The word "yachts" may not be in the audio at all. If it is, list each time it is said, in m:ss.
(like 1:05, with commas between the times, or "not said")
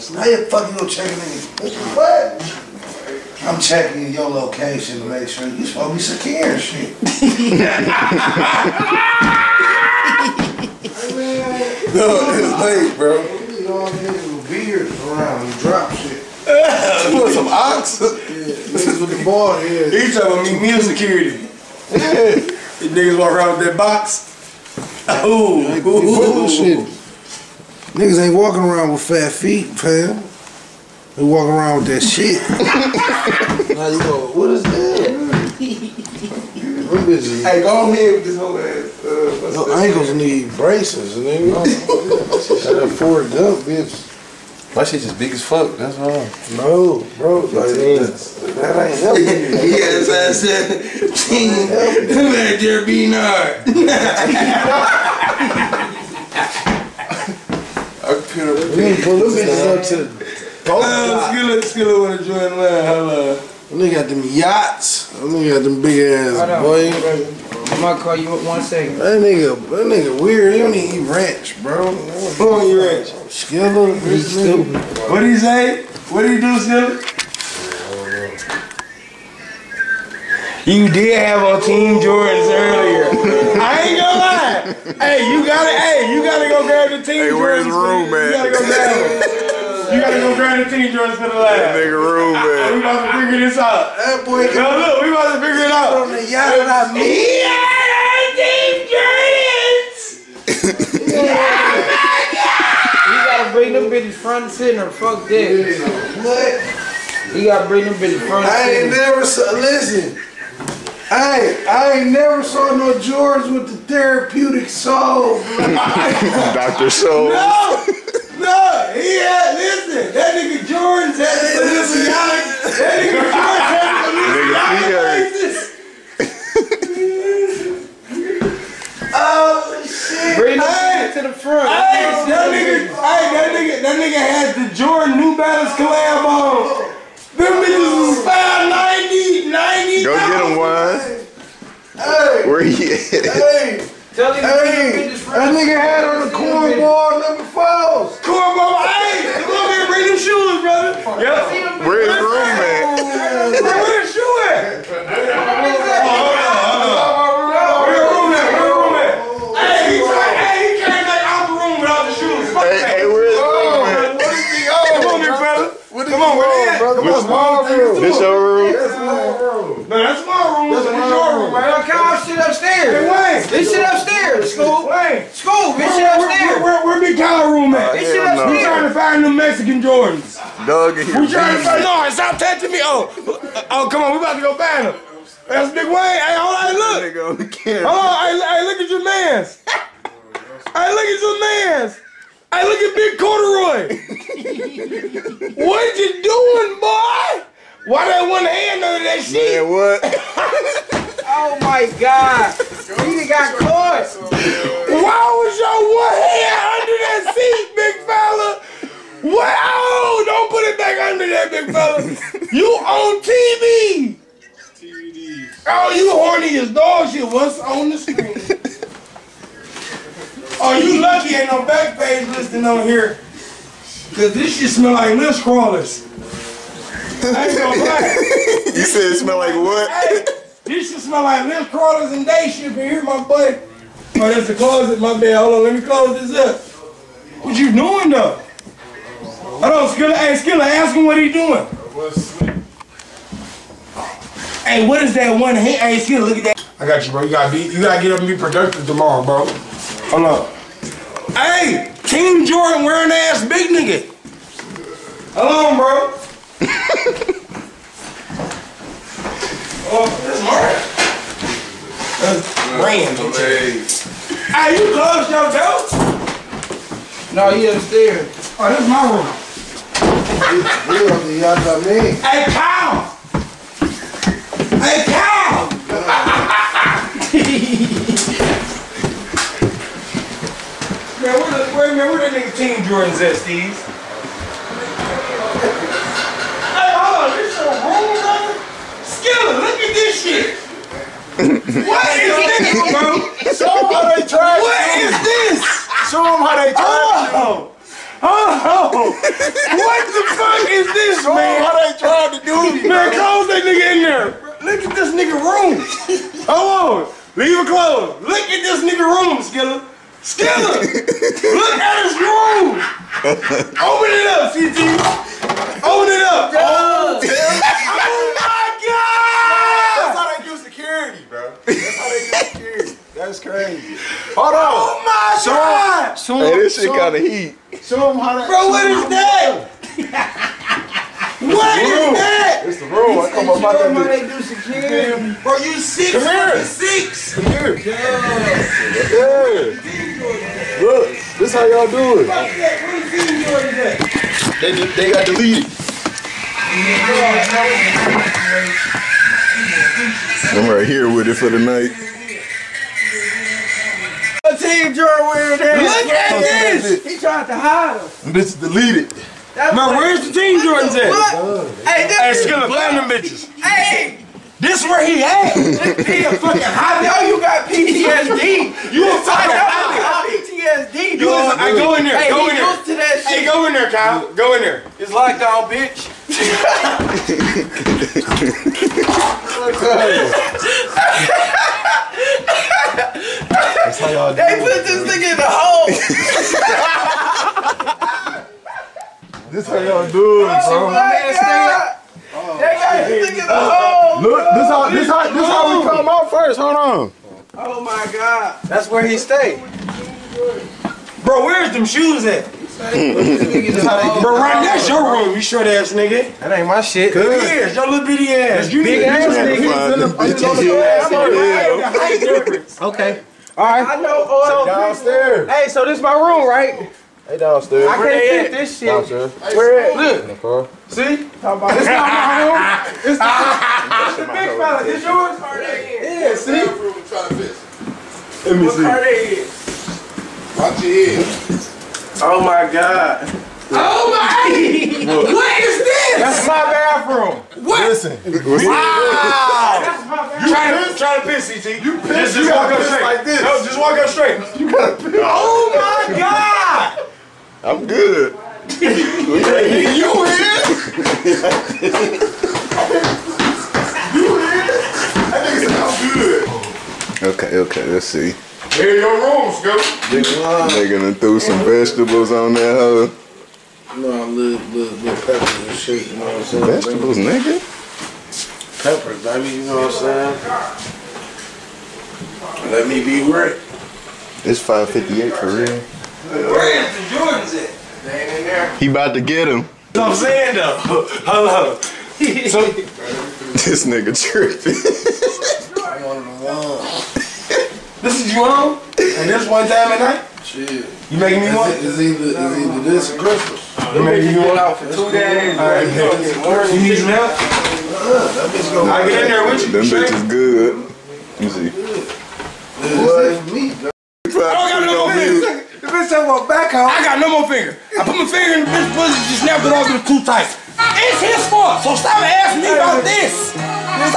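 1:04, 1:36.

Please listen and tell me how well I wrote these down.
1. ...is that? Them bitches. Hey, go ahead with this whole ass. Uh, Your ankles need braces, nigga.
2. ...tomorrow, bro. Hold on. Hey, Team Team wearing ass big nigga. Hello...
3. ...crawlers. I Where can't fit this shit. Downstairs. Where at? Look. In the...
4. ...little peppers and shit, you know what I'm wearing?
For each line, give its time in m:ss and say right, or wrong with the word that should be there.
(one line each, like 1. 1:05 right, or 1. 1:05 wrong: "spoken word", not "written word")
1. 0:34 right
2. 4:08 wrong: "Jordan", not "Team"
3. 6:57 wrong: "downstairs", not "crawlers"
4. 7:44 wrong: "saying", not "wearing".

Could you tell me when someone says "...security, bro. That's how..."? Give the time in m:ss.
5:20.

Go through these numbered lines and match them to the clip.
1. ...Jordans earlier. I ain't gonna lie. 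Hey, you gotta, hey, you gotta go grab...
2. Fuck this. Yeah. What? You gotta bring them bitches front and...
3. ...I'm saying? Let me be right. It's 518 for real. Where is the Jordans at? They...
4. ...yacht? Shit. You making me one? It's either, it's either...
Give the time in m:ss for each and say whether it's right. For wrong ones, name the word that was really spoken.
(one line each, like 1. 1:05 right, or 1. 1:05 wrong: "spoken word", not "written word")
1. 1:22 right
2. 1:44 right
3. 7:50 wrong: "558", not "518"
4. 8:09 wrong: "night", not "yacht".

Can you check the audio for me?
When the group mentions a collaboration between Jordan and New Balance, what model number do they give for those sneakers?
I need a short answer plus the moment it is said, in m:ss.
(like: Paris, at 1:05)
590, at 2:18.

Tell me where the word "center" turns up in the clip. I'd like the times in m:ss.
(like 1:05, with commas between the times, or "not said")
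1:44, 1:48.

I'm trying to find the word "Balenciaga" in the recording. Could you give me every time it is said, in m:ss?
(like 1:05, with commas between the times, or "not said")
2:01, 2:05.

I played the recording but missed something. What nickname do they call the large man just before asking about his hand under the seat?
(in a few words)
Big Corduroy.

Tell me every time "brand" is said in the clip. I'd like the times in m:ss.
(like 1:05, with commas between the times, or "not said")
4:22.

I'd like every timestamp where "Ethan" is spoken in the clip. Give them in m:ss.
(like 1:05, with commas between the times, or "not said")
not said.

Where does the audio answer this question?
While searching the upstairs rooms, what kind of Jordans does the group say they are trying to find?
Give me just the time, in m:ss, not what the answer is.
2:59.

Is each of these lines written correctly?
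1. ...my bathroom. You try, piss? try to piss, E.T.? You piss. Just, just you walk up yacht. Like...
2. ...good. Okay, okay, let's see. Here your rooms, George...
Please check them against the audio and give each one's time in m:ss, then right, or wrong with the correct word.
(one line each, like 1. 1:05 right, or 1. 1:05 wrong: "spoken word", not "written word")
1. 7:20 wrong: "straight", not "yacht"
2. 7:36 wrong: "They", not "George".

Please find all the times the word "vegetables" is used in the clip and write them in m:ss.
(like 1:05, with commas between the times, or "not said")
7:41, 7:46.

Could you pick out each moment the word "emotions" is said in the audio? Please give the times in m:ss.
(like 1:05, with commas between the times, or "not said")
not said.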